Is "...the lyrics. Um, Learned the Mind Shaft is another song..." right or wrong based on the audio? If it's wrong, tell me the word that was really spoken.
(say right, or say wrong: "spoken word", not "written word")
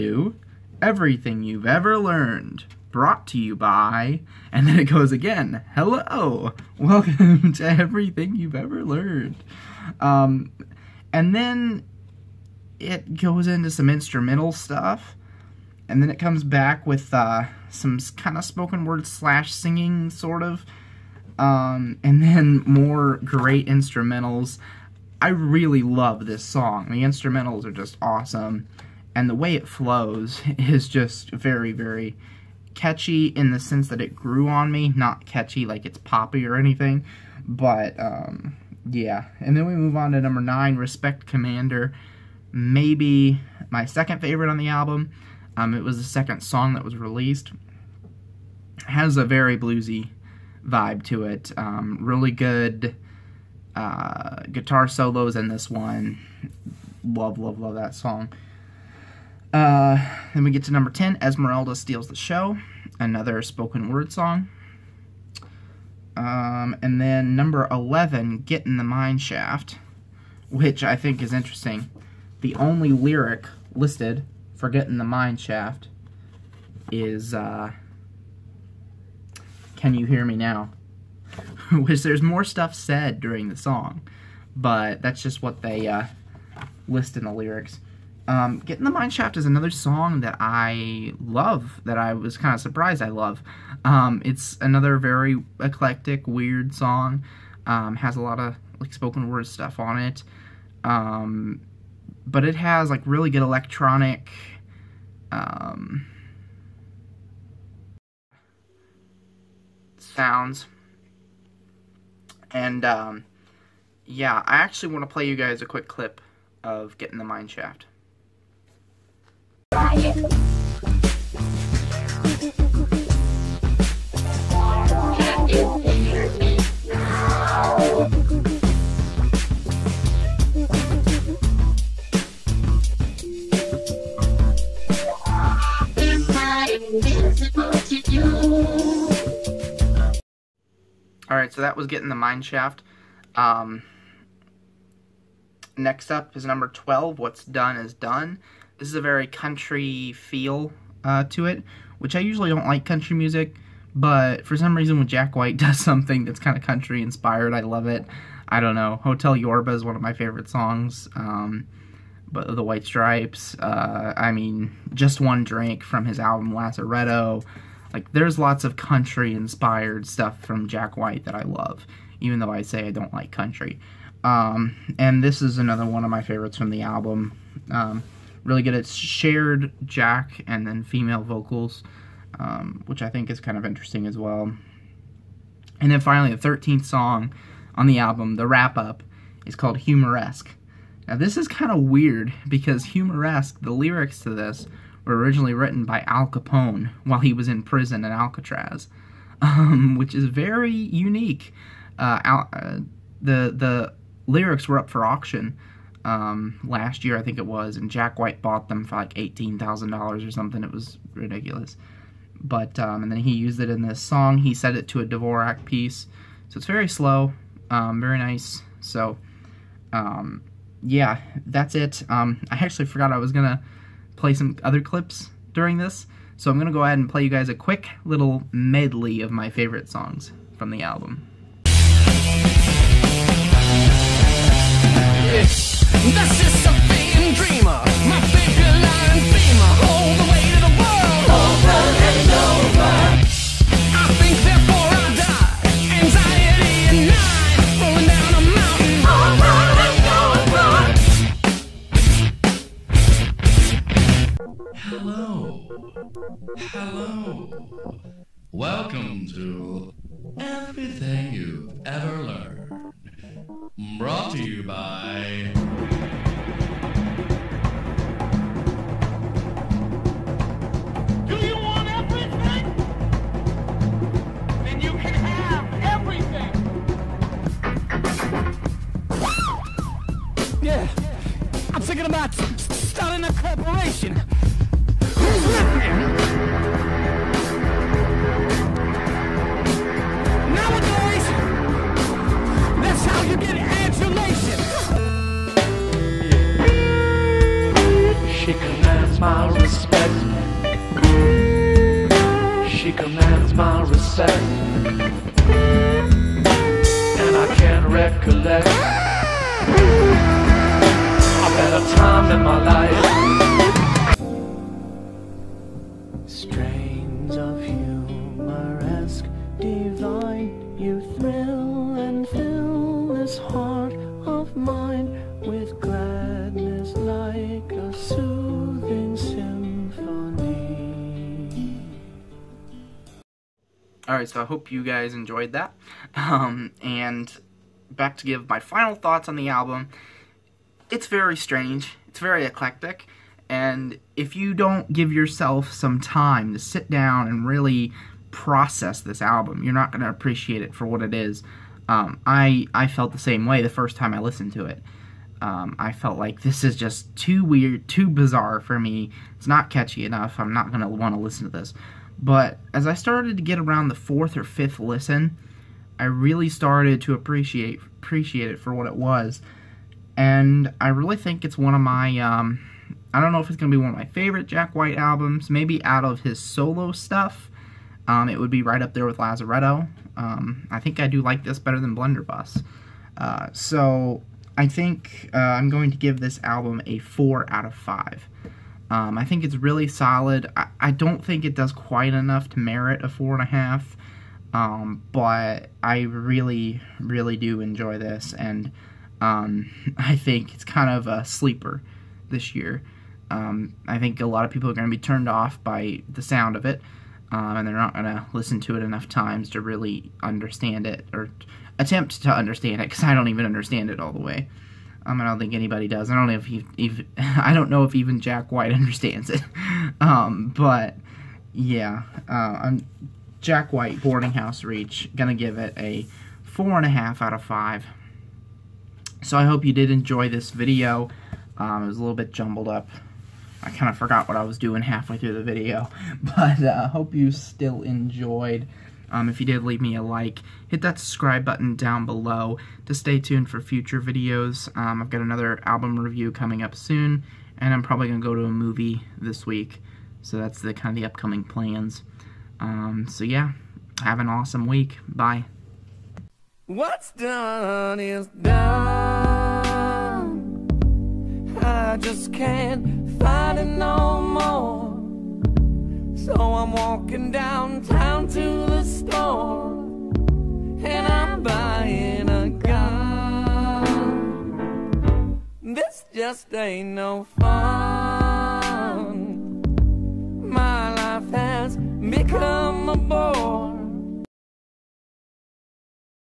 wrong: "Getting", not "Learned".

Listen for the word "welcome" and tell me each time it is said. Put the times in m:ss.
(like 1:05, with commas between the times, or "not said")
0:06.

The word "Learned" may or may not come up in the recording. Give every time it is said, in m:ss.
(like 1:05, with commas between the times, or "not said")
0:01, 0:08.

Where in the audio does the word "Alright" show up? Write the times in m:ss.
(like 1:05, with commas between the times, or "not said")
2:21, 5:34.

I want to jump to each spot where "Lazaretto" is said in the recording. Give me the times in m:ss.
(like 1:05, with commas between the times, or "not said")
2:46, 6:19.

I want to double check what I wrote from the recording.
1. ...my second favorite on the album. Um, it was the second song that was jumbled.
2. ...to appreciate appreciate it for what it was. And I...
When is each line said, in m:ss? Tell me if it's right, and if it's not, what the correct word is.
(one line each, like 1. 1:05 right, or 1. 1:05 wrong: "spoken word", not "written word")
1. 0:43 wrong: "released", not "jumbled"
2. 6:07 right.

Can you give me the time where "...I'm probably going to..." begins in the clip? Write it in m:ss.
7:27.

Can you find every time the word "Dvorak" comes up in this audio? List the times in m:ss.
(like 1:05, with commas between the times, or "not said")
3:35.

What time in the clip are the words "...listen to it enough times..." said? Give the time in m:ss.
6:48.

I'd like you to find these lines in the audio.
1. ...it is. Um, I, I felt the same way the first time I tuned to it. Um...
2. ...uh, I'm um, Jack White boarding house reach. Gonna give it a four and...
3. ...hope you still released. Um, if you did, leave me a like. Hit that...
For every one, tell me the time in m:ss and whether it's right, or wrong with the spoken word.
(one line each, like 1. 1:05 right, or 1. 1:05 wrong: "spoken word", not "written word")
1. 5:51 wrong: "listened", not "tuned"
2. 7:02 right
3. 7:16 wrong: "enjoyed", not "released".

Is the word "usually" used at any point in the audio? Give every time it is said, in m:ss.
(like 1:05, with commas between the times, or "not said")
2:32.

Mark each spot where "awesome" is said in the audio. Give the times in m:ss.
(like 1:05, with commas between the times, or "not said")
0:28, 7:34.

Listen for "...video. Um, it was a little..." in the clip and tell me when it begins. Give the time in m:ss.
7:10.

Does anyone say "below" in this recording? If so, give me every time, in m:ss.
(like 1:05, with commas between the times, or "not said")
7:22.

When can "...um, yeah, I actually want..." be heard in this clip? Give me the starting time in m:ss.
1:52.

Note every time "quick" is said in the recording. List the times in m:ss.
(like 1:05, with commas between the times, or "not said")
1:55, 3:47.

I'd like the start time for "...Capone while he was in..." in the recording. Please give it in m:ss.
3:16.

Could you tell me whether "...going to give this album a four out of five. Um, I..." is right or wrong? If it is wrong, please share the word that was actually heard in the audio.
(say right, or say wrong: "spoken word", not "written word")
right.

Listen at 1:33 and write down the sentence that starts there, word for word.
Um, it's another very eclectic, weird song.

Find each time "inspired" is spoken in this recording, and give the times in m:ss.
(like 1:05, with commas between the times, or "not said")
2:37, 2:49.